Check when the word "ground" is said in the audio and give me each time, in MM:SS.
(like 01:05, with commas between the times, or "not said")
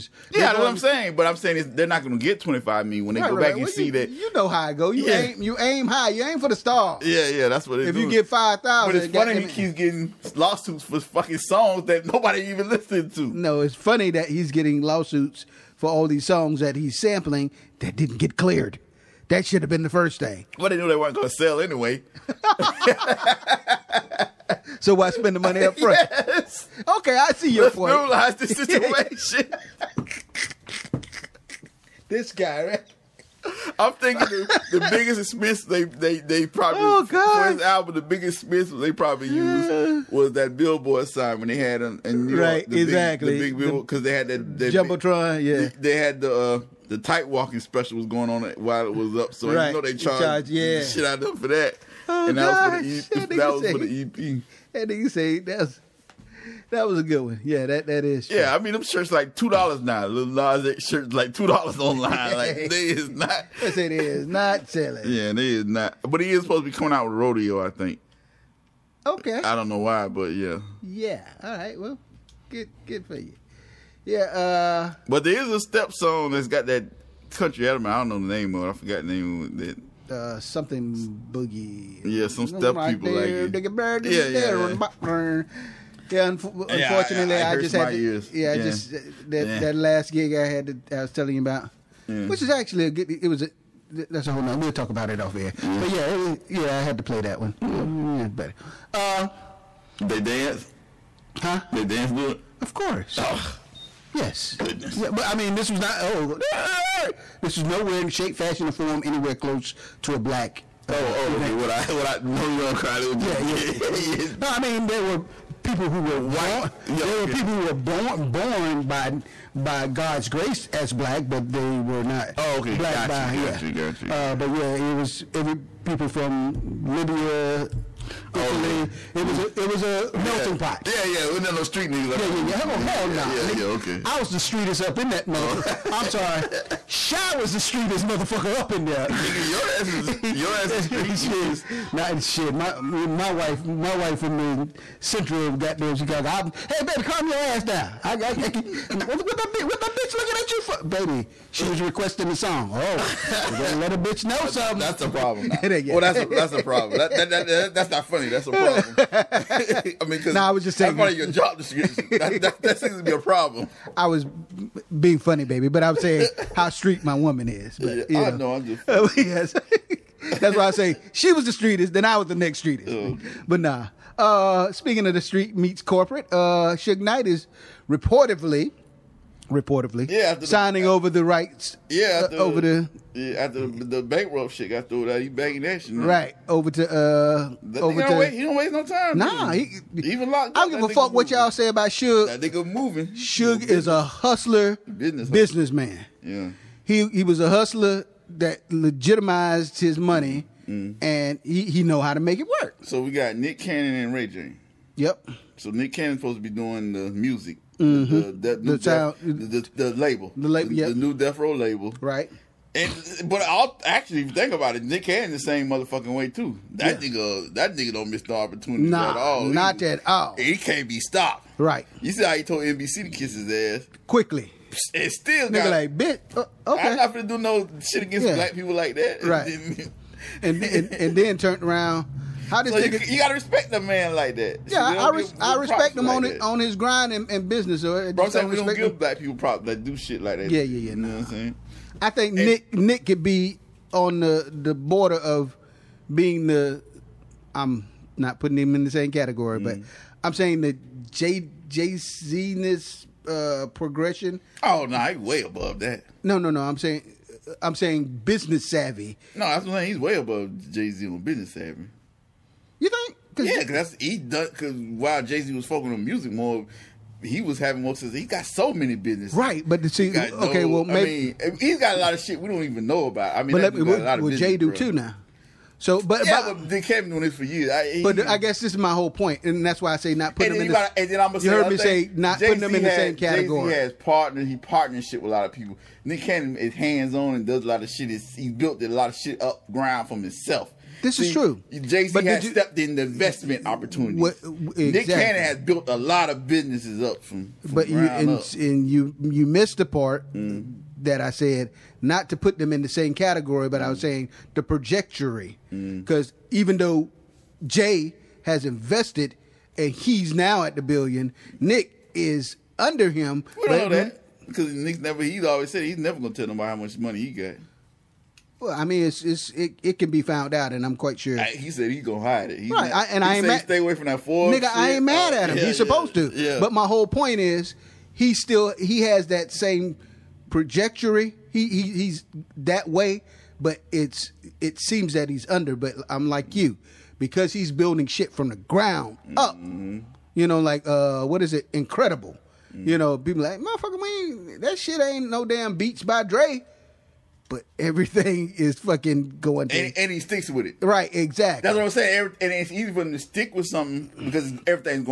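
04:49, 05:38.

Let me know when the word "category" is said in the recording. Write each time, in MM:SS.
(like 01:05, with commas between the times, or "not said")
04:09, 04:43, 05:03.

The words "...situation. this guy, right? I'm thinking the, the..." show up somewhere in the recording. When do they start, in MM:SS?
00:28.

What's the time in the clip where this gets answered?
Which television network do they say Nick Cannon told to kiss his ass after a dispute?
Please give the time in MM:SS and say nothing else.
03:42.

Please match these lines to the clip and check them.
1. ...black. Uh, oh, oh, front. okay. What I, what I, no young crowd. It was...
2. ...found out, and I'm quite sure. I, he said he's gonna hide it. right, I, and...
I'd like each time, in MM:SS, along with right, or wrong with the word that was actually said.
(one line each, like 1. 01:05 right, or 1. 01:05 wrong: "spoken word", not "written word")
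1. 01:50 wrong: "event", not "front"
2. 05:20 right.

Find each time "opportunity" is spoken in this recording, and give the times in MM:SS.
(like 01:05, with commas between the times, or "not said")
03:38, 04:53.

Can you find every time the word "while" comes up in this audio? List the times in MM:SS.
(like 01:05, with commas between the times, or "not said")
00:48, 04:24.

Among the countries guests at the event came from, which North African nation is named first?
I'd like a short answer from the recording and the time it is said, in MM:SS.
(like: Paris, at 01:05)
Libya, at 02:06.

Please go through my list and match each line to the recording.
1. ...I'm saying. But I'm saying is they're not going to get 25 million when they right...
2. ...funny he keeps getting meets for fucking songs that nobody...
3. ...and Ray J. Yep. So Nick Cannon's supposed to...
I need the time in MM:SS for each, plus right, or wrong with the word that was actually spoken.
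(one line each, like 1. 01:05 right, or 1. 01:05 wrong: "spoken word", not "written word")
1. 00:00 right
2. 00:09 wrong: "lawsuits", not "meets"
3. 03:23 right.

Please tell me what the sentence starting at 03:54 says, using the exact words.
Yeah, I, give, I respect him like on that.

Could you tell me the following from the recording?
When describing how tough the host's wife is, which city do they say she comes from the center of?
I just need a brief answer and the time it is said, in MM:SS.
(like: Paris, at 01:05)
Chicago, at 02:25.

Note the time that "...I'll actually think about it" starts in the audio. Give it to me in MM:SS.
03:33.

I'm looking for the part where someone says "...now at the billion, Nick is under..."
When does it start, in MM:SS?
05:10.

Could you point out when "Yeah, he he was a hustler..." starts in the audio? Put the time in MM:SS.
03:16.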